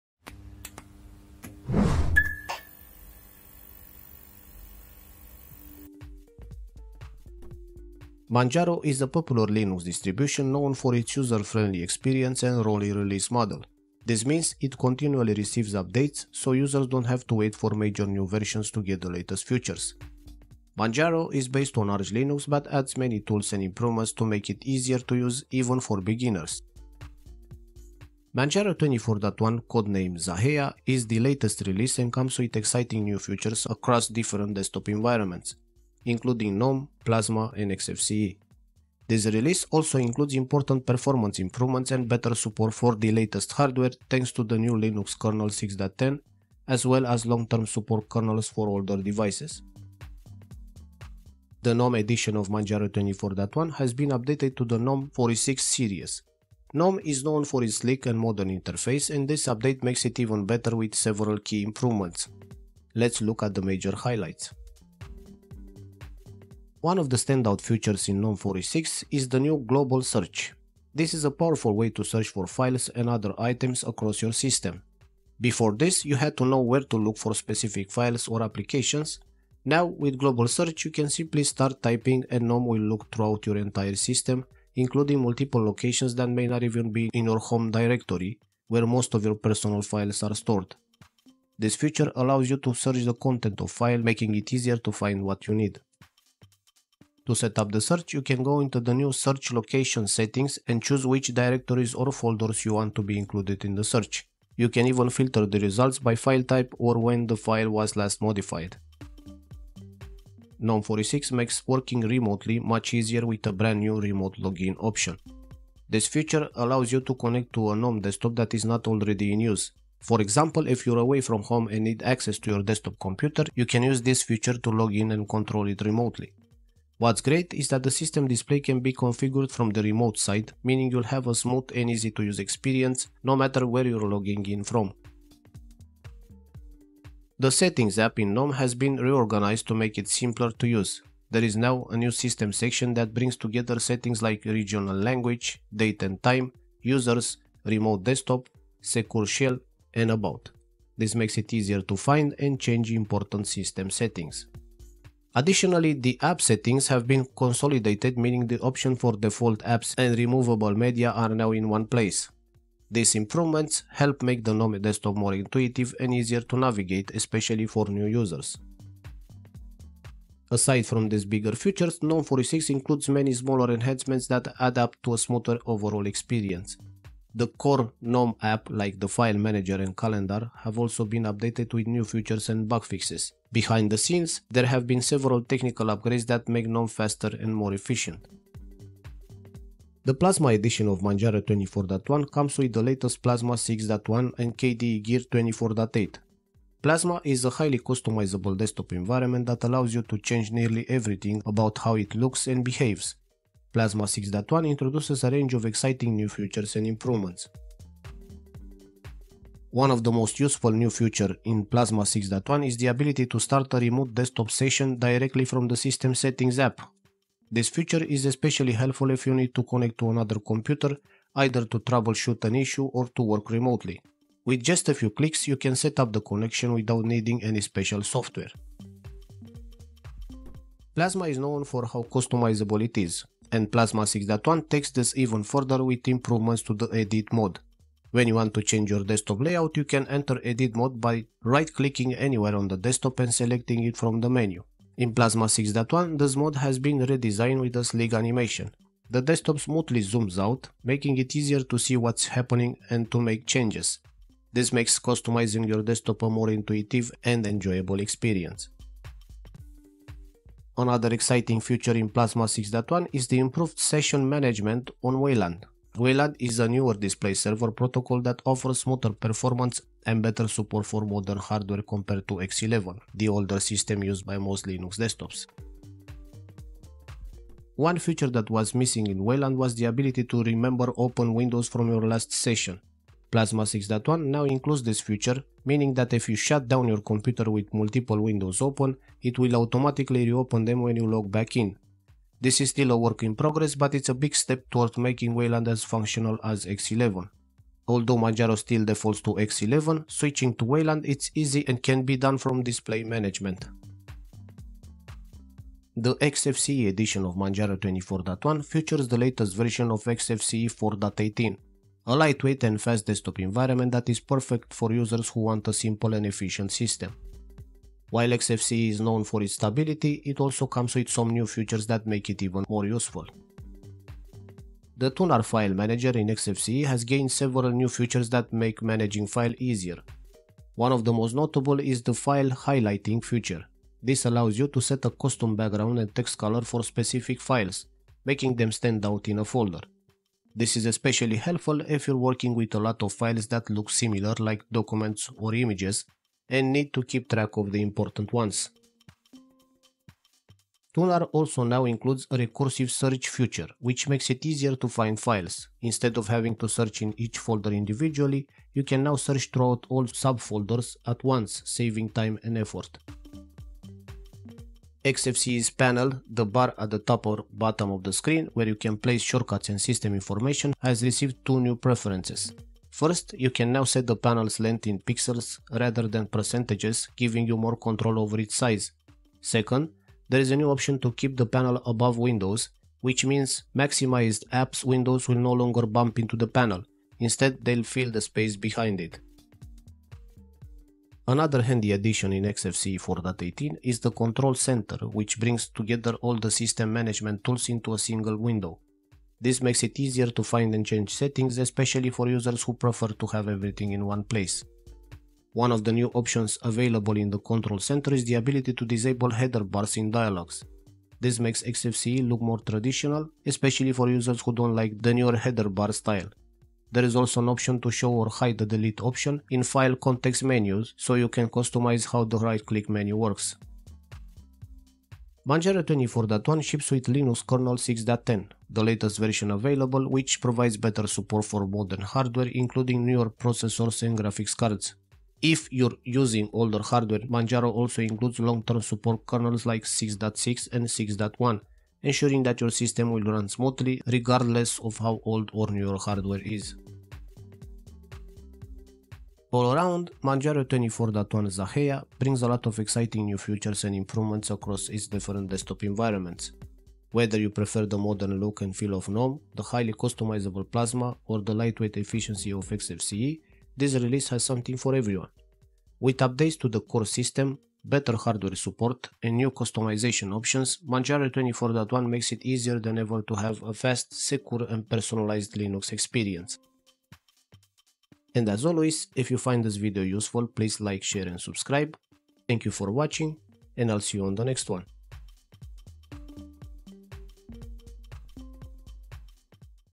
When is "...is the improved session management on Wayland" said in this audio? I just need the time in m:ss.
4:23.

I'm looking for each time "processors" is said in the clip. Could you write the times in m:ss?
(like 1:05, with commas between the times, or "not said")
7:13.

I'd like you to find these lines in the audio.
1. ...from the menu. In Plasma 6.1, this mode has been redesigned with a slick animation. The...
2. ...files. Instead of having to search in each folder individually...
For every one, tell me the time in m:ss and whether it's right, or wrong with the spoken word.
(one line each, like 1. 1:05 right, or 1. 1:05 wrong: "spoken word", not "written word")
1. 4:03 right
2. 5:55 right.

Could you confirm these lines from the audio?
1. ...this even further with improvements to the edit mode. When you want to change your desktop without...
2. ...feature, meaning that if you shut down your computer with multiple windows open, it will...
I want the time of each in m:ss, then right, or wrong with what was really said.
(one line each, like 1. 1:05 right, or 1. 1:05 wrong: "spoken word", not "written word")
1. 3:54 wrong: "layout", not "without"
2. 4:44 right.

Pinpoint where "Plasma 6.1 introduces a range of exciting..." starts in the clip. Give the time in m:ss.
3:23.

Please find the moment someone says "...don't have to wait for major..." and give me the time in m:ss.
0:16.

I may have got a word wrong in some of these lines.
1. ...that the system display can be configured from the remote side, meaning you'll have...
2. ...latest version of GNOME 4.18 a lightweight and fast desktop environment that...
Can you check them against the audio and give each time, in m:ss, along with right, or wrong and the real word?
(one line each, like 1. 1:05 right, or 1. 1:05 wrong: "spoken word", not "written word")
1. 2:07 right
2. 5:09 wrong: "XFCE", not "GNOME".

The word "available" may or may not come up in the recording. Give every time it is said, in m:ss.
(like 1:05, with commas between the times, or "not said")
6:46, 7:09.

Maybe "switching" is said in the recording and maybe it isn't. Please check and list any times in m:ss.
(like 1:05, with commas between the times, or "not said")
5:00.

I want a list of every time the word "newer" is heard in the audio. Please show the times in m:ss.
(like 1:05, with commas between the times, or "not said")
4:26, 6:55, 7:13.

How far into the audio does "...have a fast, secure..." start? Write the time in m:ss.
7:53.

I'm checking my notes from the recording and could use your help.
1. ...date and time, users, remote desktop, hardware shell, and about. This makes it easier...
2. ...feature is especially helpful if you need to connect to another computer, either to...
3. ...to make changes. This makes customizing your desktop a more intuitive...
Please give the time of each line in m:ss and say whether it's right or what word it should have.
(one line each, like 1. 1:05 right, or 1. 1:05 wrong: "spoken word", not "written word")
1. 2:25 wrong: "secure", not "hardware"
2. 3:37 right
3. 4:13 right.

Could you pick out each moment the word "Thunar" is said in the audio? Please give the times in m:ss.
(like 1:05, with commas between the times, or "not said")
5:25, 5:50.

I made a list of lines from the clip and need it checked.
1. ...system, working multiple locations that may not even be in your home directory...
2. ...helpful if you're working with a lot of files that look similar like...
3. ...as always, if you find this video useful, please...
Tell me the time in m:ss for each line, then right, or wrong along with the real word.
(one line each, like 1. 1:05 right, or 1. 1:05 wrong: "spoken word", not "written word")
1. 1:23 wrong: "including", not "working"
2. 5:41 right
3. 7:58 right.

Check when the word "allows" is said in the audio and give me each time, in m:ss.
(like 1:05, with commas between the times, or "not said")
1:32, 1:56, 3:19, 5:34.